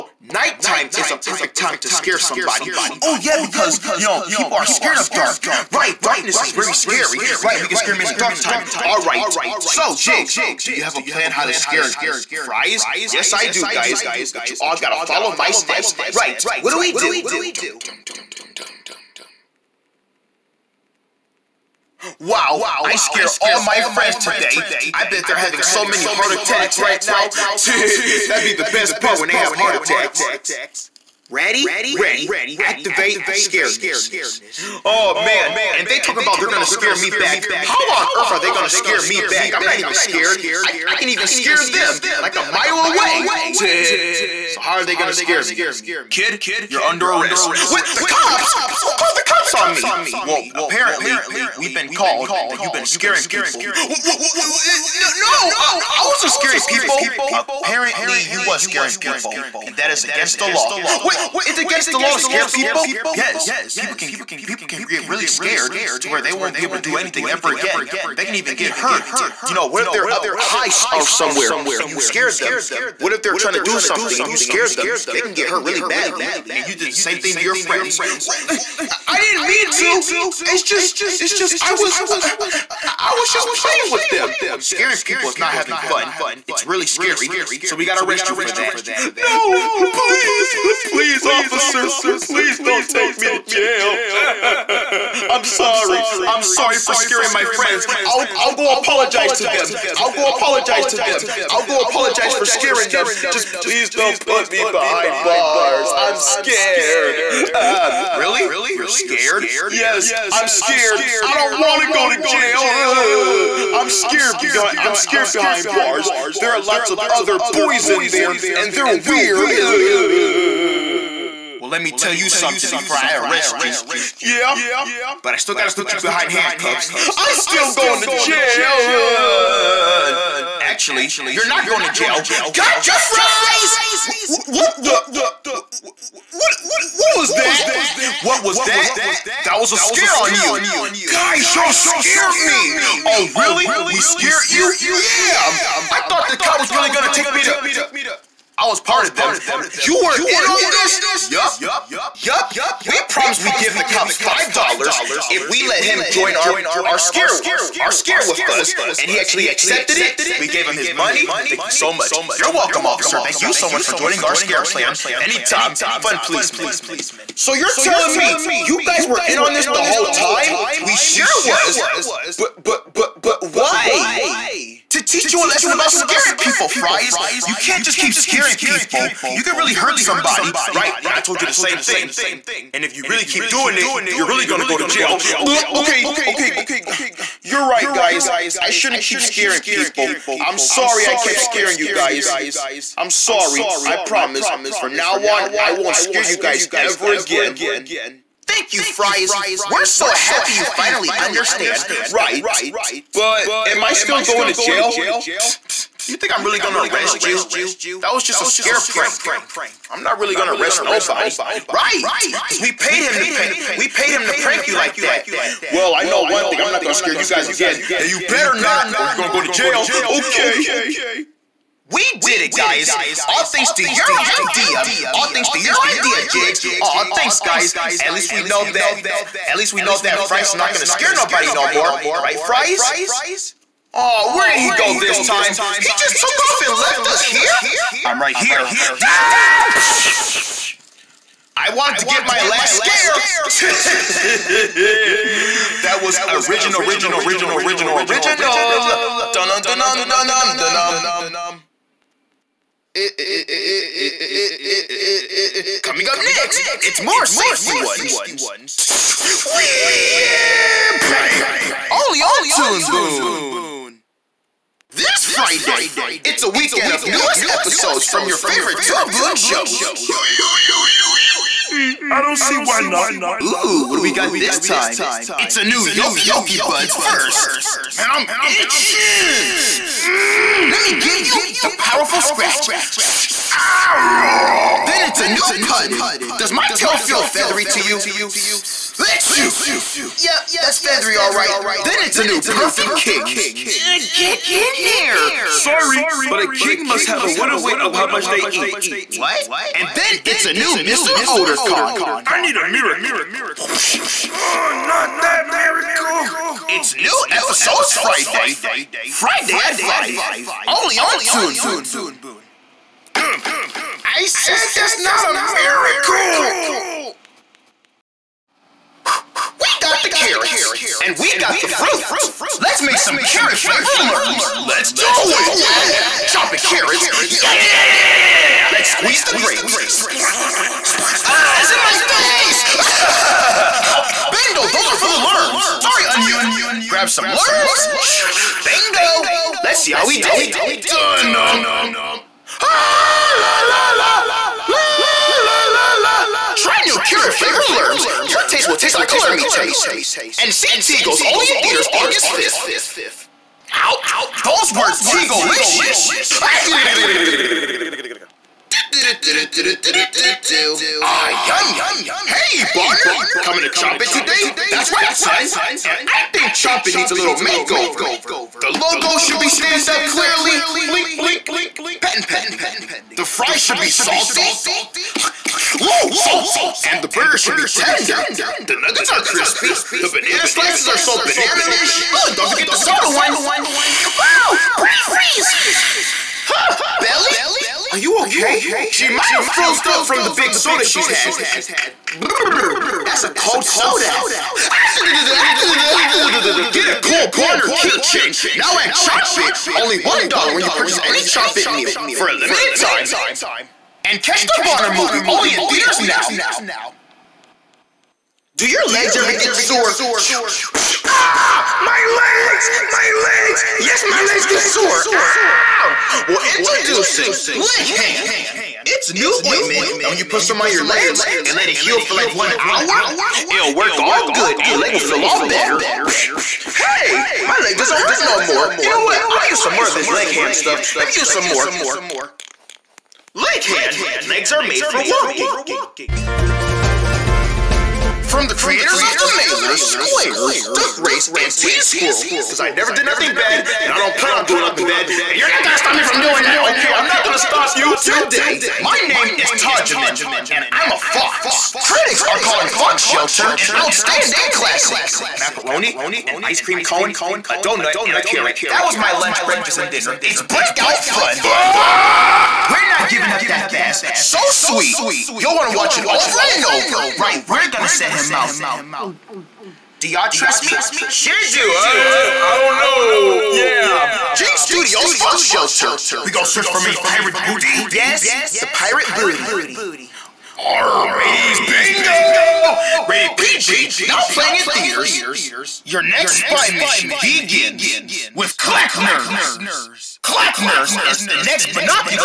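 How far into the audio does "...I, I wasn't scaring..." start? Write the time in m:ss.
0:55.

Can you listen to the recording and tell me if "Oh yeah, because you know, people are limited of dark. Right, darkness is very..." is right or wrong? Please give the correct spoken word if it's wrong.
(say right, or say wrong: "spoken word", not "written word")
wrong: "scared", not "limited".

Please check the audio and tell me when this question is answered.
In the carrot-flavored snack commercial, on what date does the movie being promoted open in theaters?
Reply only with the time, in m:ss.
5:51.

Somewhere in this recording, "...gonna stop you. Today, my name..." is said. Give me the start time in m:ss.
7:27.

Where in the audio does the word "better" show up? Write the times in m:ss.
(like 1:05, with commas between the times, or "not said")
3:38, 7:05.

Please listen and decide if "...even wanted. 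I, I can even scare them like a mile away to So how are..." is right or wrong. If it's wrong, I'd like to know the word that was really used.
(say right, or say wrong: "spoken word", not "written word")
wrong: "scared", not "wanted".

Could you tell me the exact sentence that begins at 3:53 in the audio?
Oh, where did he go this time?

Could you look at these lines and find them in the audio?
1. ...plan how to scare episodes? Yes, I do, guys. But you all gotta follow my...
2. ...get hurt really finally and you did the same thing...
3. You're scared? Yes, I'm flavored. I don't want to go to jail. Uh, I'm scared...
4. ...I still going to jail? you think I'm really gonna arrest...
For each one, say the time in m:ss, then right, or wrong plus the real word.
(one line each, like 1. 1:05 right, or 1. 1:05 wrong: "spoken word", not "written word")
1. 0:11 wrong: "fries", not "episodes"
2. 1:15 wrong: "badly", not "finally"
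3. 1:48 wrong: "scared", not "flavored"
4. 3:23 right.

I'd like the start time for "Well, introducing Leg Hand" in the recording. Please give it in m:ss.
6:56.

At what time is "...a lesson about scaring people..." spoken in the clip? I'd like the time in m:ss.
2:55.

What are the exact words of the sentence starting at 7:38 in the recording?
That was my lunch, breakfast, and dinner.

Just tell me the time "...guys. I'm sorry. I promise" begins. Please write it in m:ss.
3:11.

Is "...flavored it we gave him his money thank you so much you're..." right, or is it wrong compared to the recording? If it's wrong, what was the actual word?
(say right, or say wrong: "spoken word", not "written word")
wrong: "accepted", not "flavored".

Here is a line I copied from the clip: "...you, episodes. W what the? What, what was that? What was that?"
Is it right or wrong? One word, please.
wrong.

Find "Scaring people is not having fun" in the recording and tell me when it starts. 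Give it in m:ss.
1:24.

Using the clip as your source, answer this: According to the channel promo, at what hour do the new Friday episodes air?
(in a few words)
5.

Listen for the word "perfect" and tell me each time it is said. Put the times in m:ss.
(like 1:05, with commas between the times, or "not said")
0:01, 4:52.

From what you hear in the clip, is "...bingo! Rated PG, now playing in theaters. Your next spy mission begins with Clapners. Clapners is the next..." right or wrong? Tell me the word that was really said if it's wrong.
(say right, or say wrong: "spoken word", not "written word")
right.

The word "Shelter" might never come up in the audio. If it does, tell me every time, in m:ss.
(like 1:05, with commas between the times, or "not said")
7:33, 7:55.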